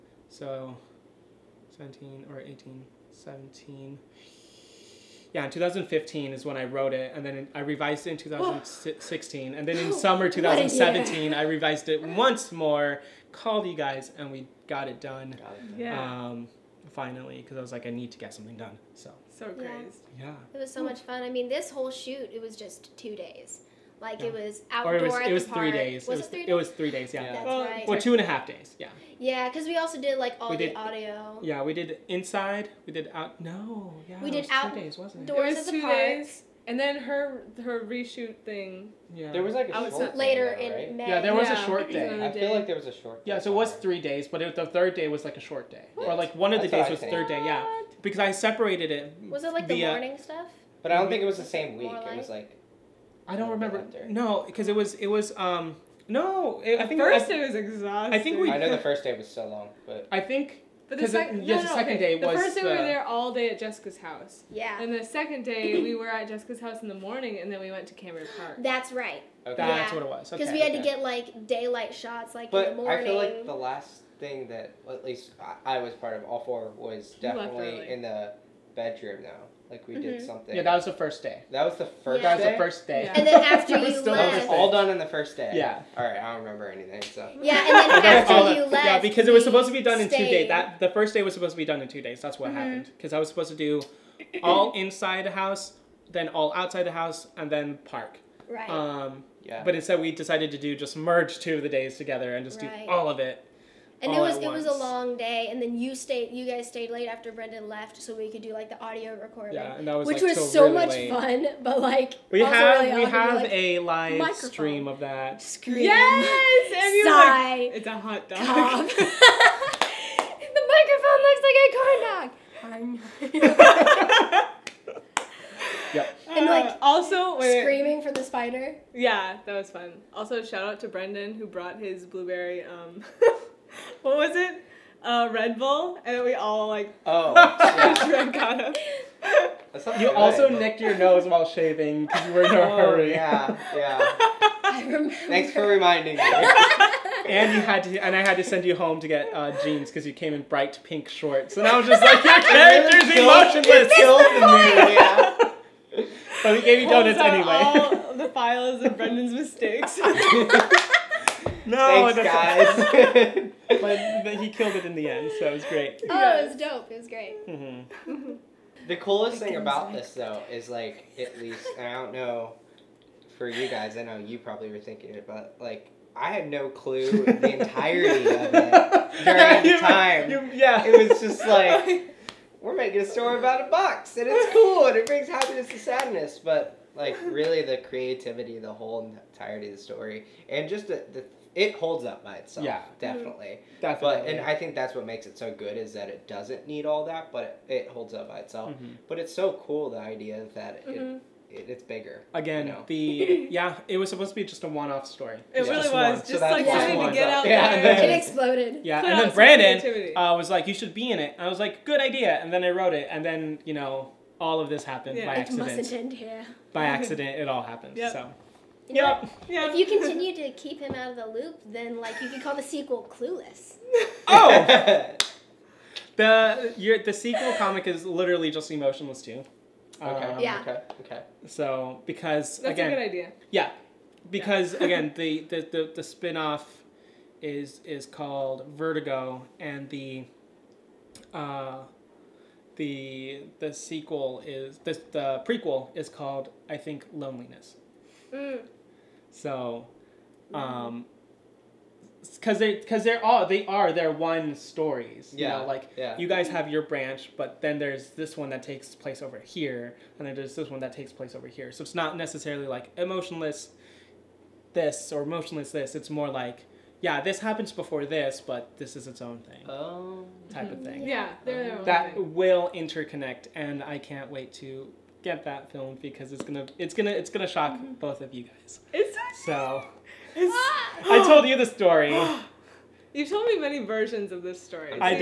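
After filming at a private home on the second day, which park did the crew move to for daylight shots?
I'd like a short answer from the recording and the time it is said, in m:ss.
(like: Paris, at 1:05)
Cameron Park, at 1:07.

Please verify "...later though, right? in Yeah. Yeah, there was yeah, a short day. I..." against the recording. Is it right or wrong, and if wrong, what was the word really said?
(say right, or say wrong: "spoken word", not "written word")
wrong: "May", not "Yeah".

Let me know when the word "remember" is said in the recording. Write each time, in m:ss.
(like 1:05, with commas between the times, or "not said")
0:53, 1:26, 2:24.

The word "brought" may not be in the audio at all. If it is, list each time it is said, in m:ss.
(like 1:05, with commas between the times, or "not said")
2:11.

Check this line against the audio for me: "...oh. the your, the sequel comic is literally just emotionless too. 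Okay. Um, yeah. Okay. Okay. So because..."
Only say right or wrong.
right.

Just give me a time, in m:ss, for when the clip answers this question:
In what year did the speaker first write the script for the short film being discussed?
0:05.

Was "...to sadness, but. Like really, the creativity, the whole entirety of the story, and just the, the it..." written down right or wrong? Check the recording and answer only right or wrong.
right.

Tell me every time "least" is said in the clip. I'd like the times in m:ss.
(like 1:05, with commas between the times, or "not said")
1:15, 2:51.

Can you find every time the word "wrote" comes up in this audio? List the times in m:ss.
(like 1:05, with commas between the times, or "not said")
0:06, 3:32.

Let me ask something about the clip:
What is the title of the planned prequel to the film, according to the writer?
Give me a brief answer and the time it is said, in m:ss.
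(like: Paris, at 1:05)
Loneliness, at 4:07.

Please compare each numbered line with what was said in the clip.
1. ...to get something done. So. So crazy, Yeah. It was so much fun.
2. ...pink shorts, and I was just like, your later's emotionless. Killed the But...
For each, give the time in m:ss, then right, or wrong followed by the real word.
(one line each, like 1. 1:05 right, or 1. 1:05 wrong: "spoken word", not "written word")
1. 0:18 right
2. 2:30 wrong: "character", not "later".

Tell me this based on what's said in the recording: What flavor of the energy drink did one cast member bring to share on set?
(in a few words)
Blueberry.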